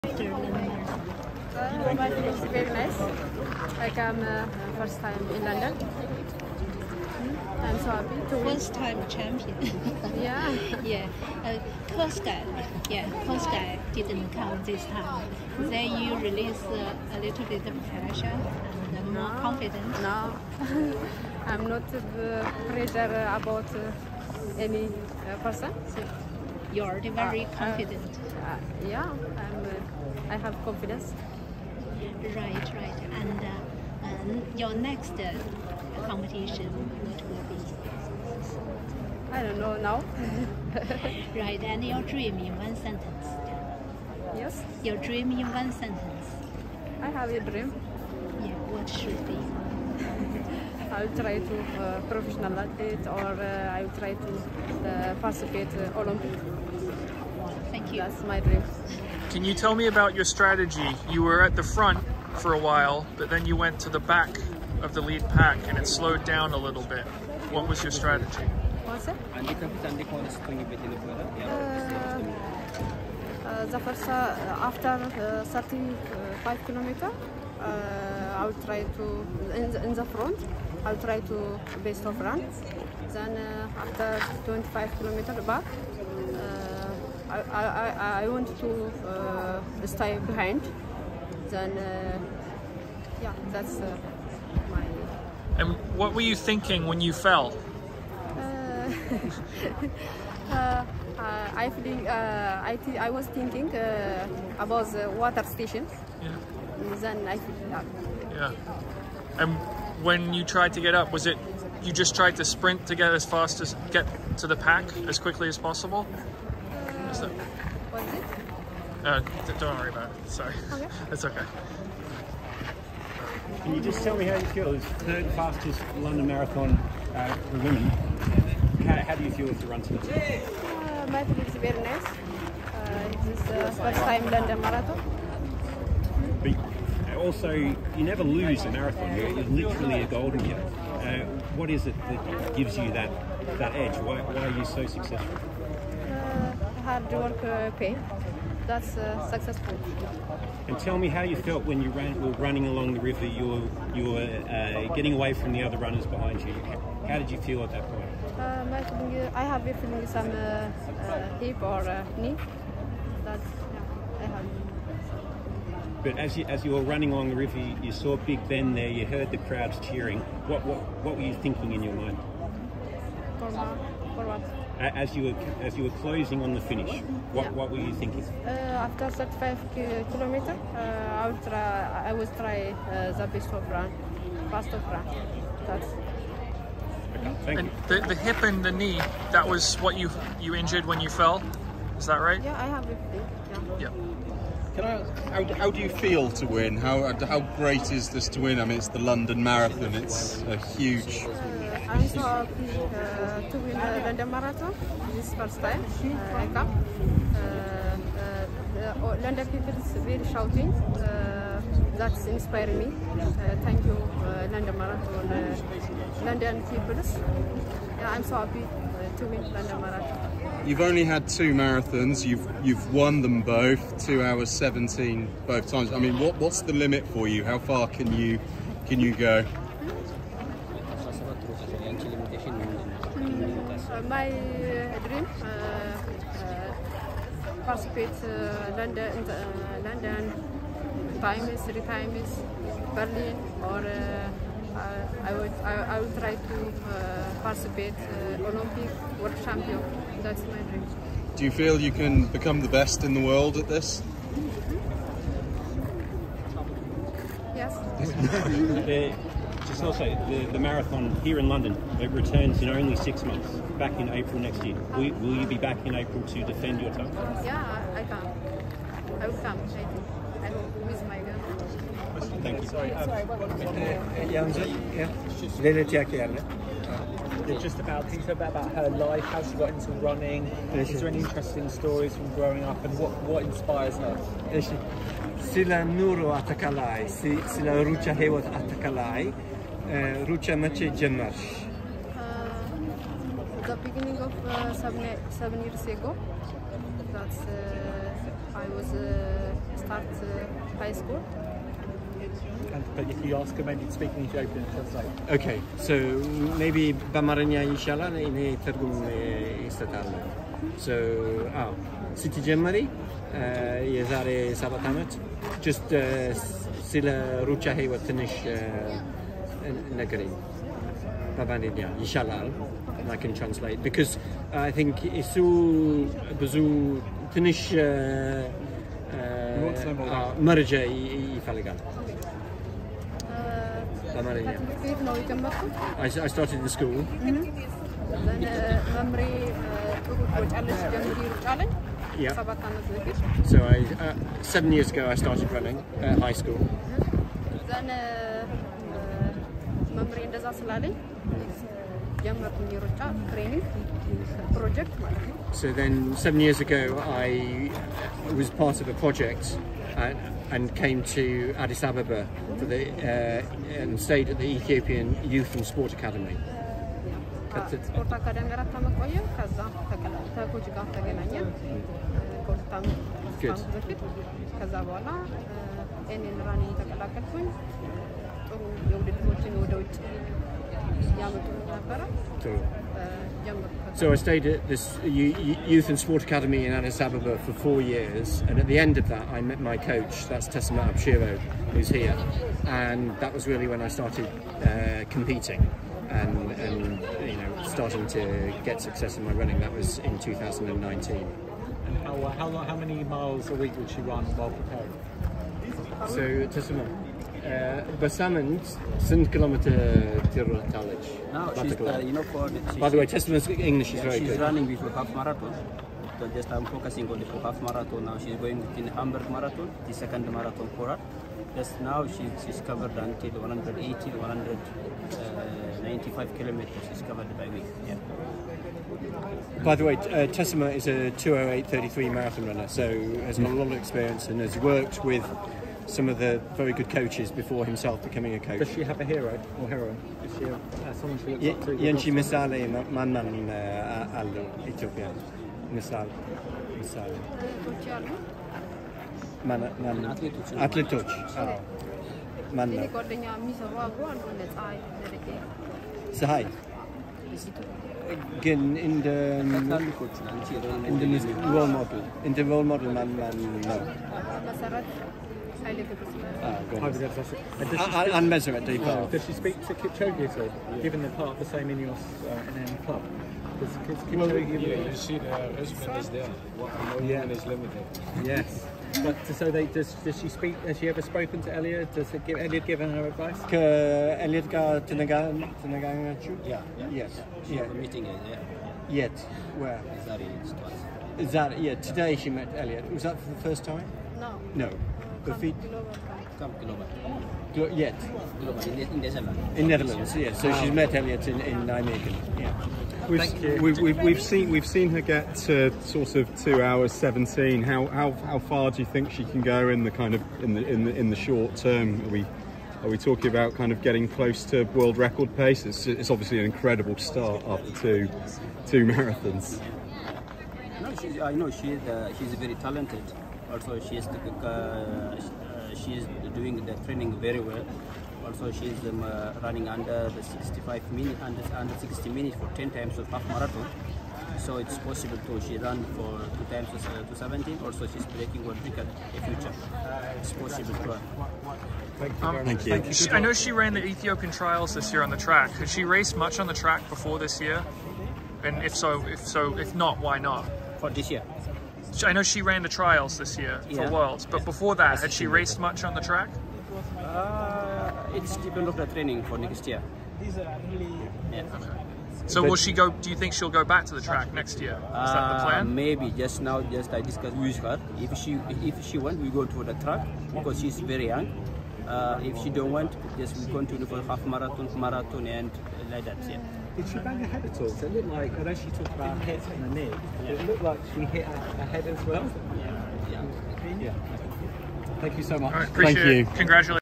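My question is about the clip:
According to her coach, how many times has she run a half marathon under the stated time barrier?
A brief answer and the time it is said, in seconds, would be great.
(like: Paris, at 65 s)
10, at 532 s.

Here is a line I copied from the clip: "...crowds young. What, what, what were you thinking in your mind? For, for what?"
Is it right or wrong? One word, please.
wrong.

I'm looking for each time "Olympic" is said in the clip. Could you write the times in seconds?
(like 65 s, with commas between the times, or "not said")
55 s, 248 s.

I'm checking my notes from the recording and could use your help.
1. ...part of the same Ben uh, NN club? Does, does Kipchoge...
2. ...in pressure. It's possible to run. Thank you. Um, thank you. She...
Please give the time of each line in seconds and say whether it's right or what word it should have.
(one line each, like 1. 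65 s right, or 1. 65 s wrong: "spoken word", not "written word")
1. 471 s wrong: "Ineos", not "Ben"
2. 539 s wrong: "future", not "pressure".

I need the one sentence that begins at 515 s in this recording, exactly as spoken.
It's, it's obviously an incredible start after two two marathons.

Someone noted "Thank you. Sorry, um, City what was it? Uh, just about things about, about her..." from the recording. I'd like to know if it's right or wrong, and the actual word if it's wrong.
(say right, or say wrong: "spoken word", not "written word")
wrong: "Sorry", not "City".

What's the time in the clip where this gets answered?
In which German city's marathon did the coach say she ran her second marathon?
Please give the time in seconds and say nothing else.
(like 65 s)
418 s.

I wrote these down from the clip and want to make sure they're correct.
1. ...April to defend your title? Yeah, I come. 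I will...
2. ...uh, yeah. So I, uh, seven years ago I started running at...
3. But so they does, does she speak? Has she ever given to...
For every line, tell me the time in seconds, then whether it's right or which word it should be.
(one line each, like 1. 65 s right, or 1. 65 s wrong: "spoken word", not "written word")
1. 265 s right
2. 341 s right
3. 479 s wrong: "spoken", not "given".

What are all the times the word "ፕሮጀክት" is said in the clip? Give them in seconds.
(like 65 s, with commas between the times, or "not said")
354 s.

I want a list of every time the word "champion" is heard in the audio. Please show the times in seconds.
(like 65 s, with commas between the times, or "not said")
9 s, 249 s.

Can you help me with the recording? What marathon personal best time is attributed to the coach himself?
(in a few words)
2:08:33.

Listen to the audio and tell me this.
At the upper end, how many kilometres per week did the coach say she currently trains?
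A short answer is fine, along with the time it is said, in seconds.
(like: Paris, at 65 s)
195, at 424 s.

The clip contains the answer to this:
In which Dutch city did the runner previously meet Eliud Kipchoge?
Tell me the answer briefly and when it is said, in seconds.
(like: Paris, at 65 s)
Nijmegen, at 501 s.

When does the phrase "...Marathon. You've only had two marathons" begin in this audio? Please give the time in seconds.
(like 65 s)
219 s.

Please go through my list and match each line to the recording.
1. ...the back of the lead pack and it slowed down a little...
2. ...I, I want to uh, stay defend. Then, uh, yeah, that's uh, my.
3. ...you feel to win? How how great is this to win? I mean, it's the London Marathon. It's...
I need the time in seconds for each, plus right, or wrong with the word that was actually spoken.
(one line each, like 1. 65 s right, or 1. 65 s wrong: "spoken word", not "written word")
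1. 63 s right
2. 87 s wrong: "behind", not "defend"
3. 195 s right.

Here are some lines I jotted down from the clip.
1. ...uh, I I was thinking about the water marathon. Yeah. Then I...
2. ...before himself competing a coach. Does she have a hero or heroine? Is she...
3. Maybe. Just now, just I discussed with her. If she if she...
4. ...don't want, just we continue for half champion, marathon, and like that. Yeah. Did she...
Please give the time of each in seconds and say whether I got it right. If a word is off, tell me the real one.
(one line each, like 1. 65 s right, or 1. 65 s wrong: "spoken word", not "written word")
1. 102 s wrong: "station", not "marathon"
2. 437 s wrong: "becoming", not "competing"
3. 565 s right
4. 572 s wrong: "marathon", not "champion".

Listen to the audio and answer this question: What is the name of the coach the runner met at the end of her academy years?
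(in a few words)
Tessima Abshiro.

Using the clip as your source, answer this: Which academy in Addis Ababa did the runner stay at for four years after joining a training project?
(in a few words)
Ethiopian Youth and Sport Academy.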